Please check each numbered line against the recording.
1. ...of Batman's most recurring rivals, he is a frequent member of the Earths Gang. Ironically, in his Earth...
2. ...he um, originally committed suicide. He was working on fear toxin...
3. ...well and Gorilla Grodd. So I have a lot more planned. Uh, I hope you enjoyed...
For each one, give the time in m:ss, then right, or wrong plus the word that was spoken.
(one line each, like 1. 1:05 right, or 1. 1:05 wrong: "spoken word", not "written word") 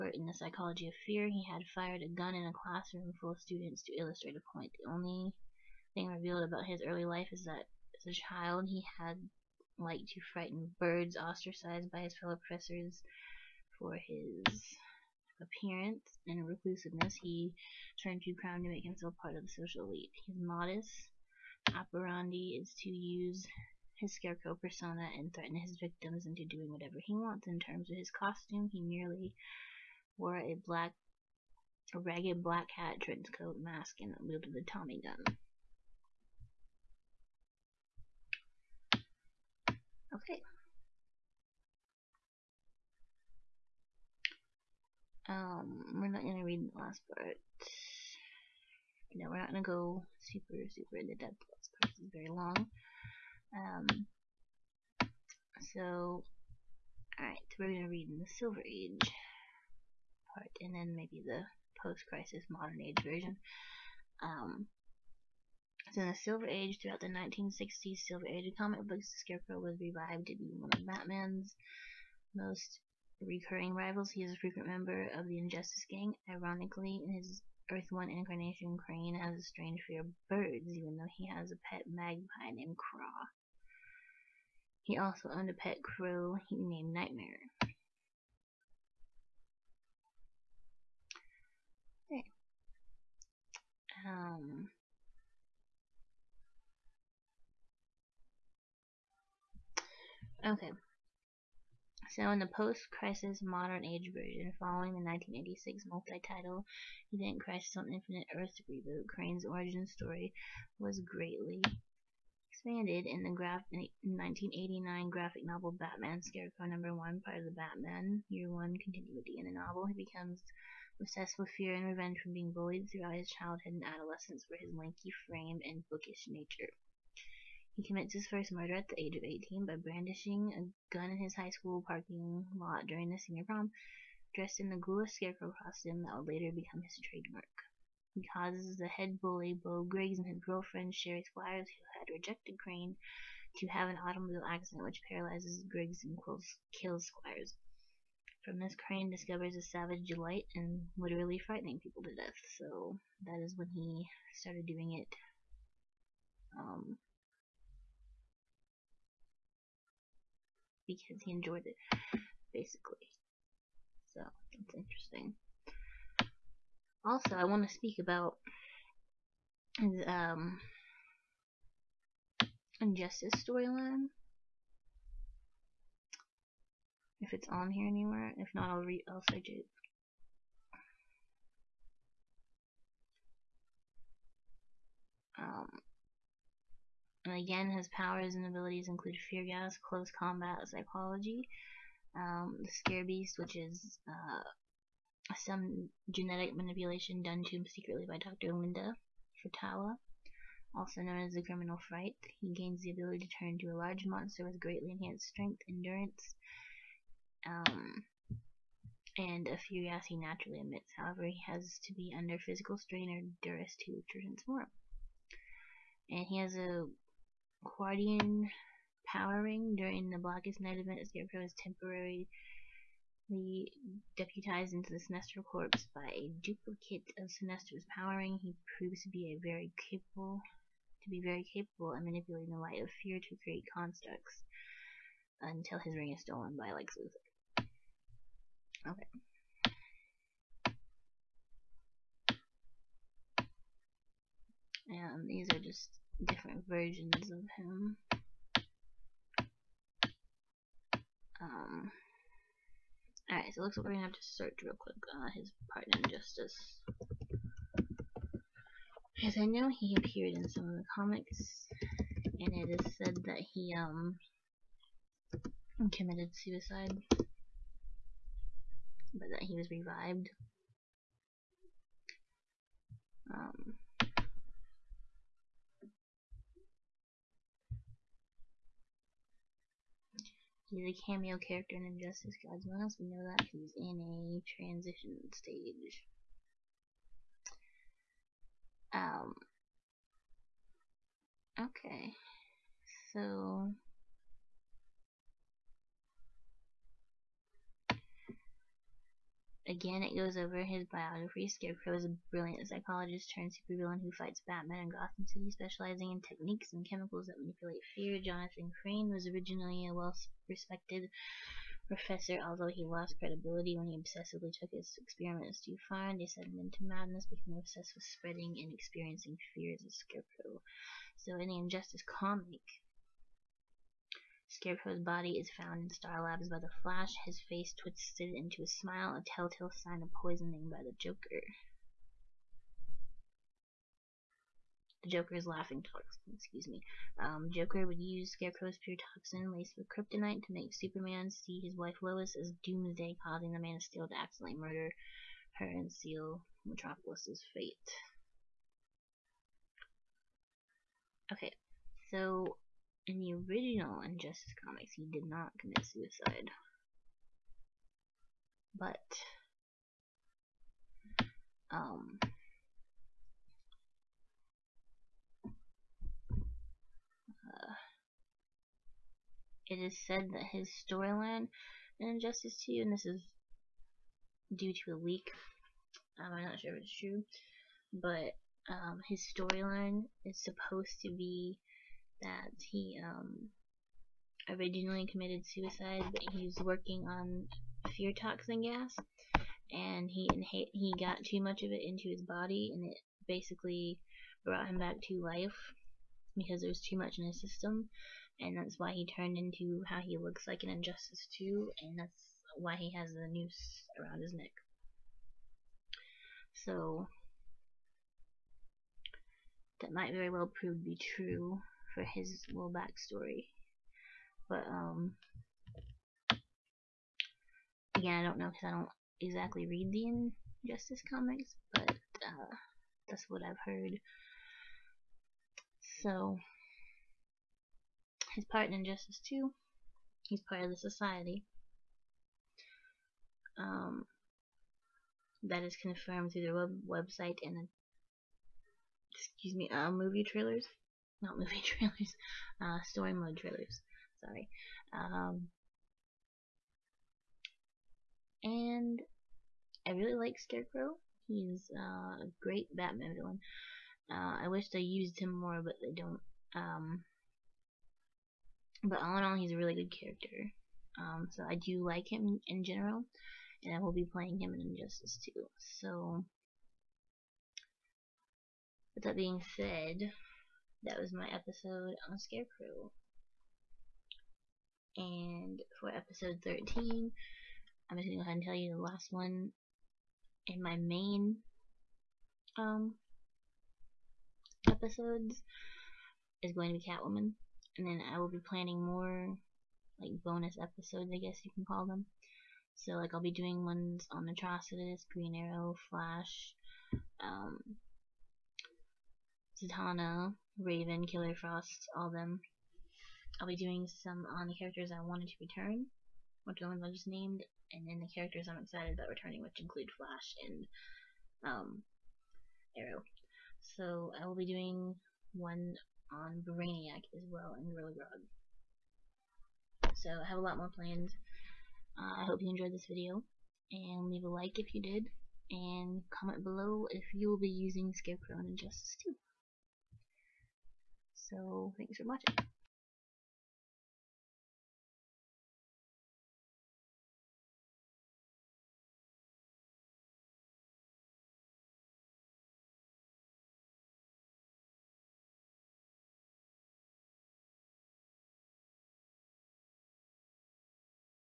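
1. 1:10 wrong: "Injustice", not "Earths"
2. 6:22 right
3. 8:37 right.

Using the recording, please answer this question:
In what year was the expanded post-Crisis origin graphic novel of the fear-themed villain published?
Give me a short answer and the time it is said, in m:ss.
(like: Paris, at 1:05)
1989, at 1:53.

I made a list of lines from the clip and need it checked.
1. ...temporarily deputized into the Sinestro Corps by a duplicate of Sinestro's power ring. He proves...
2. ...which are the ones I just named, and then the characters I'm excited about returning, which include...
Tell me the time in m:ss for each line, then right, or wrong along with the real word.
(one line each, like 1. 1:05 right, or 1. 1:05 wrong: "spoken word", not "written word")
1. 3:41 right
2. 8:26 right.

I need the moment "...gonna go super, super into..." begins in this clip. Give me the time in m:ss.
0:49.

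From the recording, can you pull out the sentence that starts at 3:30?
However, he has to be under physical strain or duress to transform.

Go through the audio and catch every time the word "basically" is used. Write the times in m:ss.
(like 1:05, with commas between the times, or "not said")
2:42, 6:33.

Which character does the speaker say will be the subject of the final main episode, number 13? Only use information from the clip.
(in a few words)
Catwoman.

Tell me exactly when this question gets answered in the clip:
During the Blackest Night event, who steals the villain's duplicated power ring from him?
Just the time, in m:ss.
3:56.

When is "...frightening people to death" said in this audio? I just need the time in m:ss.
2:31.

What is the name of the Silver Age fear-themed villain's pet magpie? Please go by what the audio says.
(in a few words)
Craw.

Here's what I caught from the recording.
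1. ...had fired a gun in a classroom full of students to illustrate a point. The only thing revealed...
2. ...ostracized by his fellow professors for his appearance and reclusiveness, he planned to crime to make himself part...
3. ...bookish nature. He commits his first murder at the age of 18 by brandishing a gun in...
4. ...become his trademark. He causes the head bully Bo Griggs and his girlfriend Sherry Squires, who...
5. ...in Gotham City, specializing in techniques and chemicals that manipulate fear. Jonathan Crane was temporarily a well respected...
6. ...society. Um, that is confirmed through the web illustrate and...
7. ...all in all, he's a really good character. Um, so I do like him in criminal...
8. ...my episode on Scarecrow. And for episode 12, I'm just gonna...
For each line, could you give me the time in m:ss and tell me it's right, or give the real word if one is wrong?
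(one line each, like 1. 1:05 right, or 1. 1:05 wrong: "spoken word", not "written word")
1. 0:01 right
2. 0:11 wrong: "turned", not "planned"
3. 2:05 right
4. 2:16 right
5. 5:04 wrong: "originally", not "temporarily"
6. 7:10 wrong: "website", not "illustrate"
7. 7:38 wrong: "general", not "criminal"
8. 7:51 wrong: "13", not "12".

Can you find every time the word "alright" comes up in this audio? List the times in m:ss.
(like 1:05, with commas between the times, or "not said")
0:57, 4:13.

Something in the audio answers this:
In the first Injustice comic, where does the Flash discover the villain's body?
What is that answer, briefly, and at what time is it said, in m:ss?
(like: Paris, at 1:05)
Star Labs, at 5:25.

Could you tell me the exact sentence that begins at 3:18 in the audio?
Linda Friitawa, also known as the criminal fright.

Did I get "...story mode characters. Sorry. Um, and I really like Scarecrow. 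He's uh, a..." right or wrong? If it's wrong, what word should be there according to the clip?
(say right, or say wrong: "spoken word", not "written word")
wrong: "trailers", not "characters".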